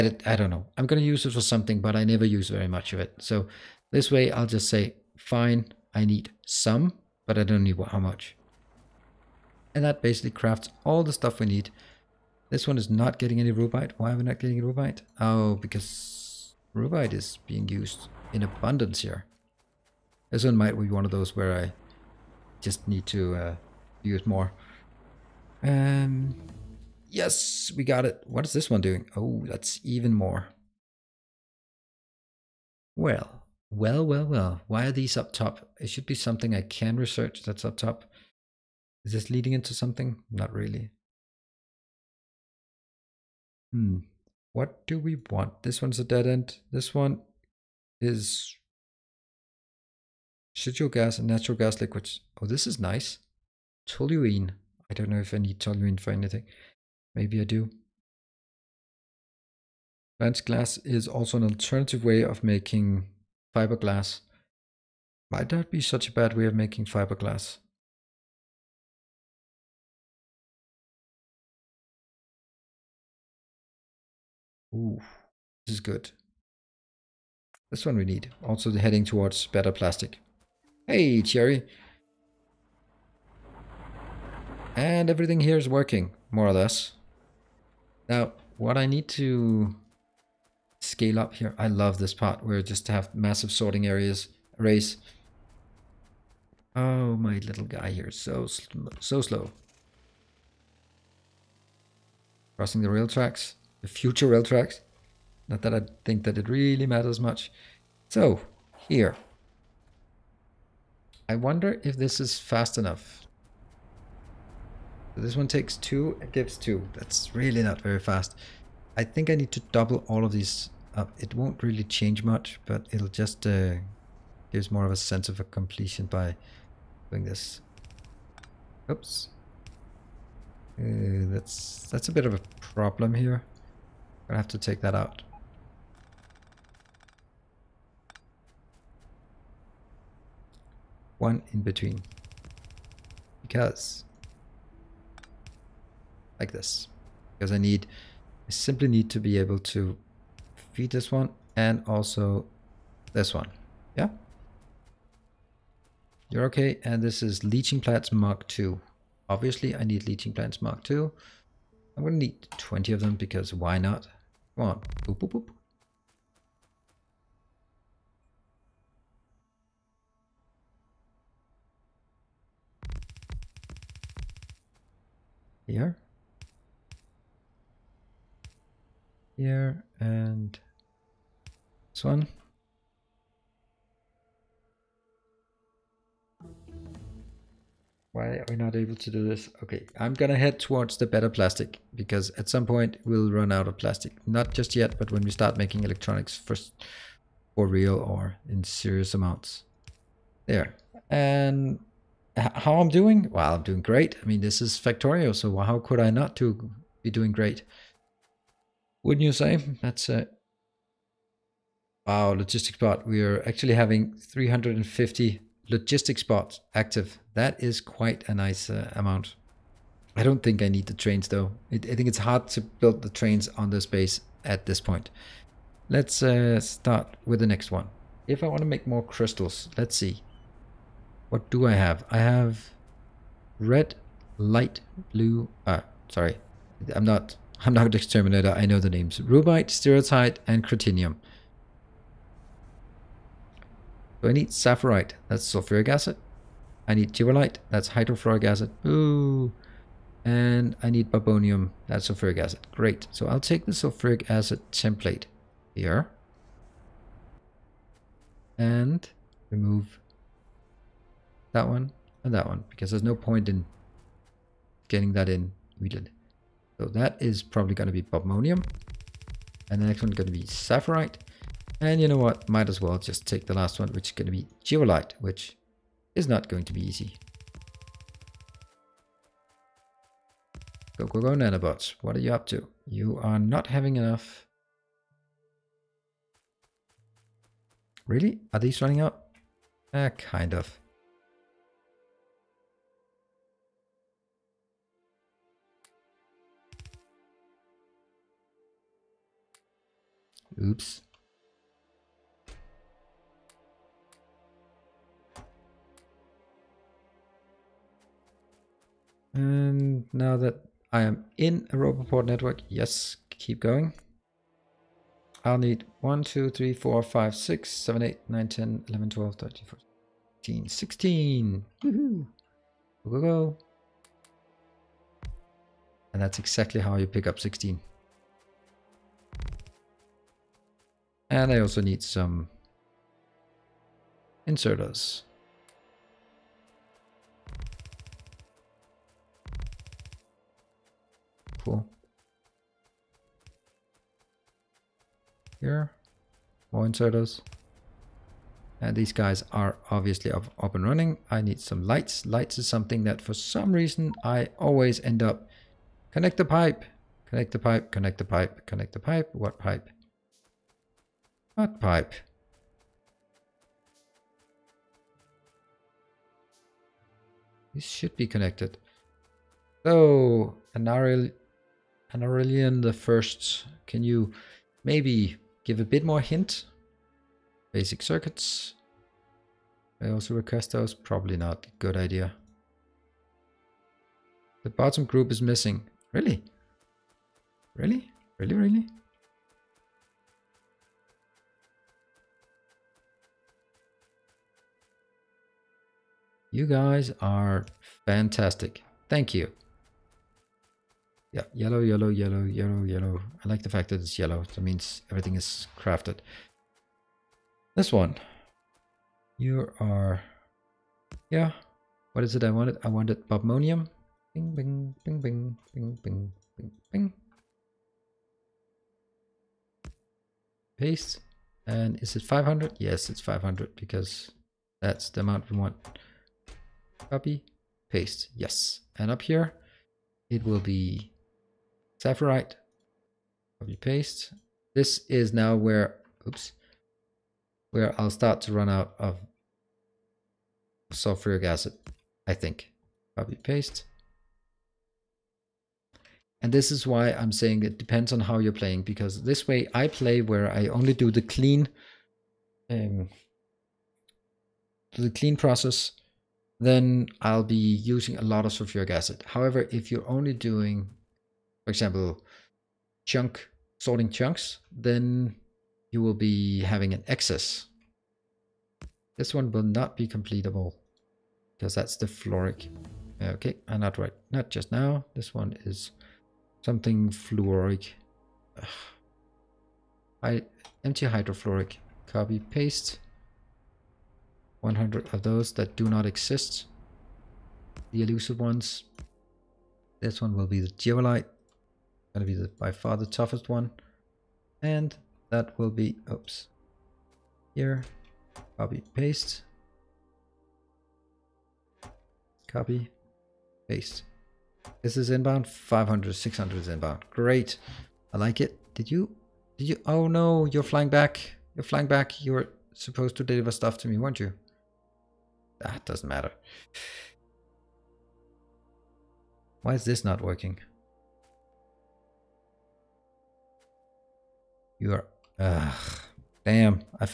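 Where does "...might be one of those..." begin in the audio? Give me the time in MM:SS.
00:20.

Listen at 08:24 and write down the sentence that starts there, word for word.
This is inbound, 500, 600 is inbound.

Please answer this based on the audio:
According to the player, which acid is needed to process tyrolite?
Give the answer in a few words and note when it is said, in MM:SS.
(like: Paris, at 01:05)
Hydrofluoric acid, at 04:07.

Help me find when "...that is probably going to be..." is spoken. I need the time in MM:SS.
04:26.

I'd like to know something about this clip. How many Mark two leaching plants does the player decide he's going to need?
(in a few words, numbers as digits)
20.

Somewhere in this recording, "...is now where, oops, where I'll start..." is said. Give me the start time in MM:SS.
07:15.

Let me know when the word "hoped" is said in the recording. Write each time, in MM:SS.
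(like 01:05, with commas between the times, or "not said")
not said.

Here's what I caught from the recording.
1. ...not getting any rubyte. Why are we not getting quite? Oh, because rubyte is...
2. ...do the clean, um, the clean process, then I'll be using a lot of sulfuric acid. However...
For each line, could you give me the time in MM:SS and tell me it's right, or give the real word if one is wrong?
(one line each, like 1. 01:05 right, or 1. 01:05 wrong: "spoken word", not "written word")
1. 00:12 wrong: "rubyte", not "quite"
2. 07:30 right.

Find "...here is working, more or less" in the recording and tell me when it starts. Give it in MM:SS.
01:25.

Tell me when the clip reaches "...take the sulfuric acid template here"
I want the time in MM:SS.
04:13.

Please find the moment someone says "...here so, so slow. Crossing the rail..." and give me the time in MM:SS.
01:37.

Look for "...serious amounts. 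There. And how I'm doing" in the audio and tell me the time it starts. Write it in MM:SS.
03:18.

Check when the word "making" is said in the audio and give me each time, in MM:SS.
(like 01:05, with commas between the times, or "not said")
01:02, 01:06, 03:15.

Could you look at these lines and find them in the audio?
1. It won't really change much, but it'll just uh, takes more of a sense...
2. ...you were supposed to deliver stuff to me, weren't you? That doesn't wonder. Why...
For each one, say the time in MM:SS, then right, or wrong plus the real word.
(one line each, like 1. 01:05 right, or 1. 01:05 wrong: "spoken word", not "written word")
1. 02:01 wrong: "gives", not "takes"
2. 08:32 wrong: "matter", not "wonder".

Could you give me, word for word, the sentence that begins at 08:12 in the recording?
Gonna be the, by far the toughest one.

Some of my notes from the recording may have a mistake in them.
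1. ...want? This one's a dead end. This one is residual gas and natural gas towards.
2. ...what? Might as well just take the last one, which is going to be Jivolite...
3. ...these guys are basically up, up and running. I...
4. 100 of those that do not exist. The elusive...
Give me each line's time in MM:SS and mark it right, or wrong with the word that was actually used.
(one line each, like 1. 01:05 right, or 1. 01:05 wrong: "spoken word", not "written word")
1. 00:45 wrong: "liquids", not "towards"
2. 04:32 right
3. 05:48 wrong: "obviously", not "basically"
4. 08:04 right.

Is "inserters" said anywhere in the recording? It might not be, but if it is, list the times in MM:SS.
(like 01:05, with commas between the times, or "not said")
05:34, 05:46.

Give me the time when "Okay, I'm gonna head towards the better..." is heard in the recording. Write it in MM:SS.
03:09.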